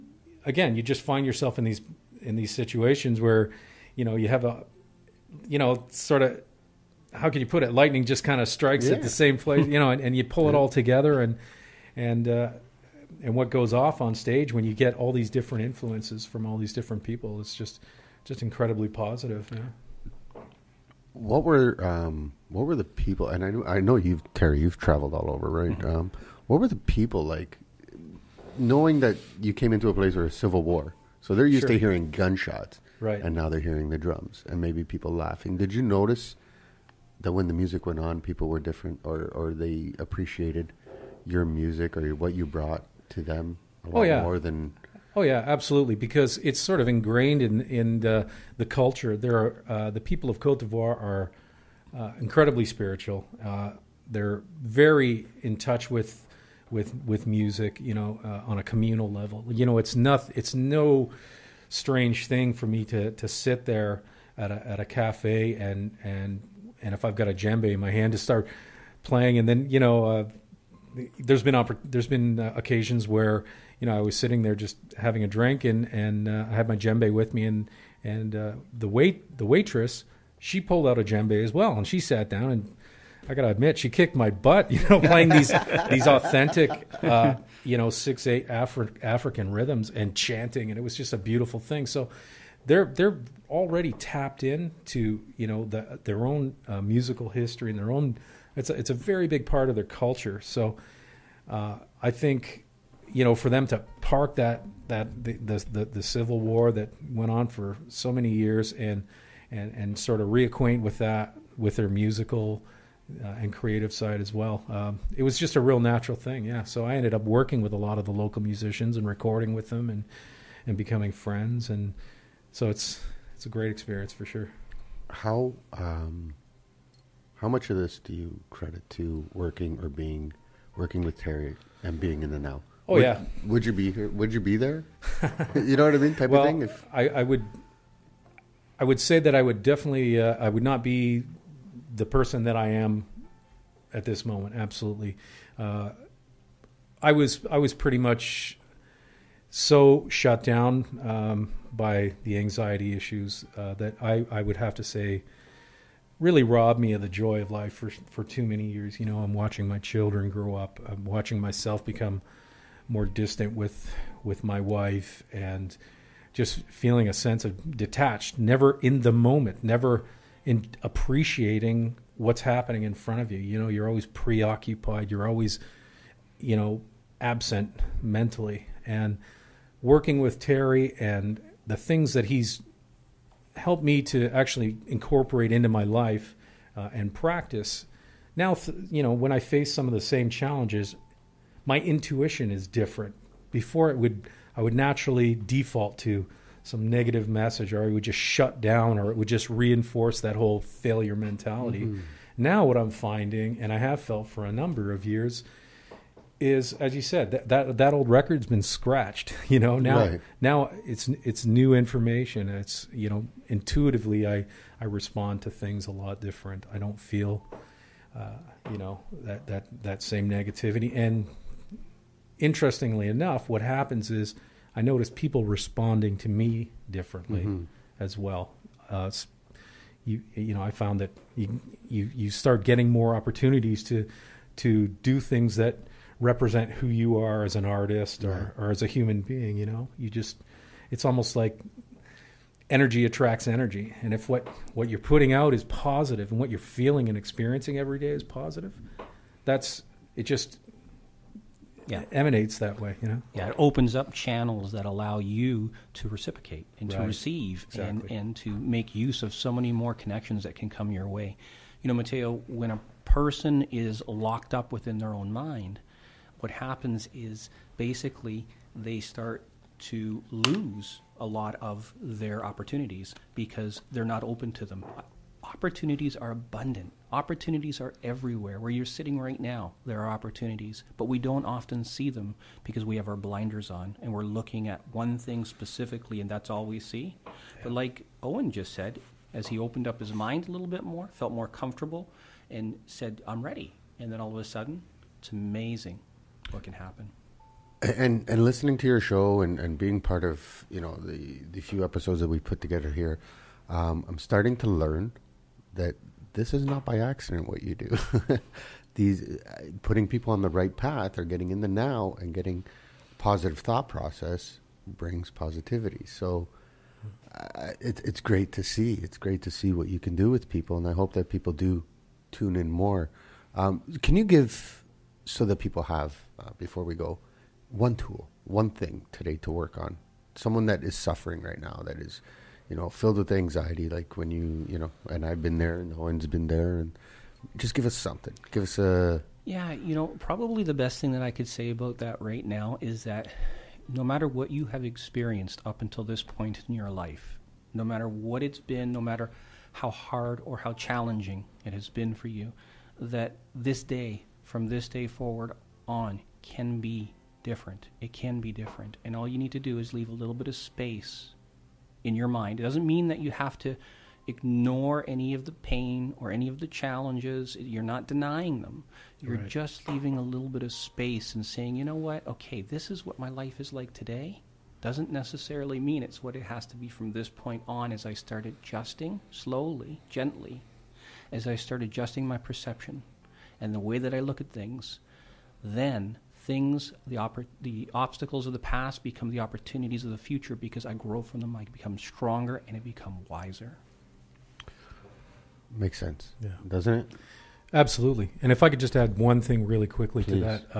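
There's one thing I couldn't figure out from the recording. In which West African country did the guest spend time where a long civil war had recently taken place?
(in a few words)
Cote d'Ivoire.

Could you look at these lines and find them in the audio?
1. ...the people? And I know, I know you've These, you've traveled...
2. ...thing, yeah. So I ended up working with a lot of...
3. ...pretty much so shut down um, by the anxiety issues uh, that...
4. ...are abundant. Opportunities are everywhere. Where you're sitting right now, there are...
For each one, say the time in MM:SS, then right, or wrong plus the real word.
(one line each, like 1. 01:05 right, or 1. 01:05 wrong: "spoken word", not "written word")
1. 00:22 wrong: "Terry", not "These"
2. 01:56 right
3. 02:27 right
4. 04:36 right.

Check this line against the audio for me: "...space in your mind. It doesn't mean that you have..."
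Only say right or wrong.
right.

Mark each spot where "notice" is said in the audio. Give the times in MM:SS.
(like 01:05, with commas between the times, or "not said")
00:35, 03:44.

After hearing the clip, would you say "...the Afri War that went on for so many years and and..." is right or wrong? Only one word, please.
wrong.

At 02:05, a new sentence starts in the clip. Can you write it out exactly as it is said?
How um, how much of this do you credit to working or being working with Terry and being in the now?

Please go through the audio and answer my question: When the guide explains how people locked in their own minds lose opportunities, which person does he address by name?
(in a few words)
Mateo.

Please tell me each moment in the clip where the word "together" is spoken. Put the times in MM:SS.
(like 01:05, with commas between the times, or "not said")
00:10, 05:02.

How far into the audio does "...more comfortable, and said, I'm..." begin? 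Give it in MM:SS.
04:51.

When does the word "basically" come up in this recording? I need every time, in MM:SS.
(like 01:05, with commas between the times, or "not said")
04:27.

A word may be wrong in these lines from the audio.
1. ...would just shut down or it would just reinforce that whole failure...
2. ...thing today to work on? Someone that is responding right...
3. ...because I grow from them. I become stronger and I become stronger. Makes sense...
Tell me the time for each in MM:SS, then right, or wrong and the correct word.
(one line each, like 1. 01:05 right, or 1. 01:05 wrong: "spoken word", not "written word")
1. 03:17 right
2. 05:28 wrong: "suffering", not "responding"
3. 06:30 wrong: "wiser", not "stronger".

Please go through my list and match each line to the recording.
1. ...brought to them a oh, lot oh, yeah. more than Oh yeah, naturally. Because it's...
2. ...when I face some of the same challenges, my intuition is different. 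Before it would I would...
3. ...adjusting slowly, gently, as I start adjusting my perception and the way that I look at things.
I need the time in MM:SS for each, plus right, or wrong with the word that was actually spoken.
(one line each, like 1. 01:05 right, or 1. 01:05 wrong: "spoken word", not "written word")
1. 00:42 wrong: "absolutely", not "naturally"
2. 03:09 right
3. 06:18 right.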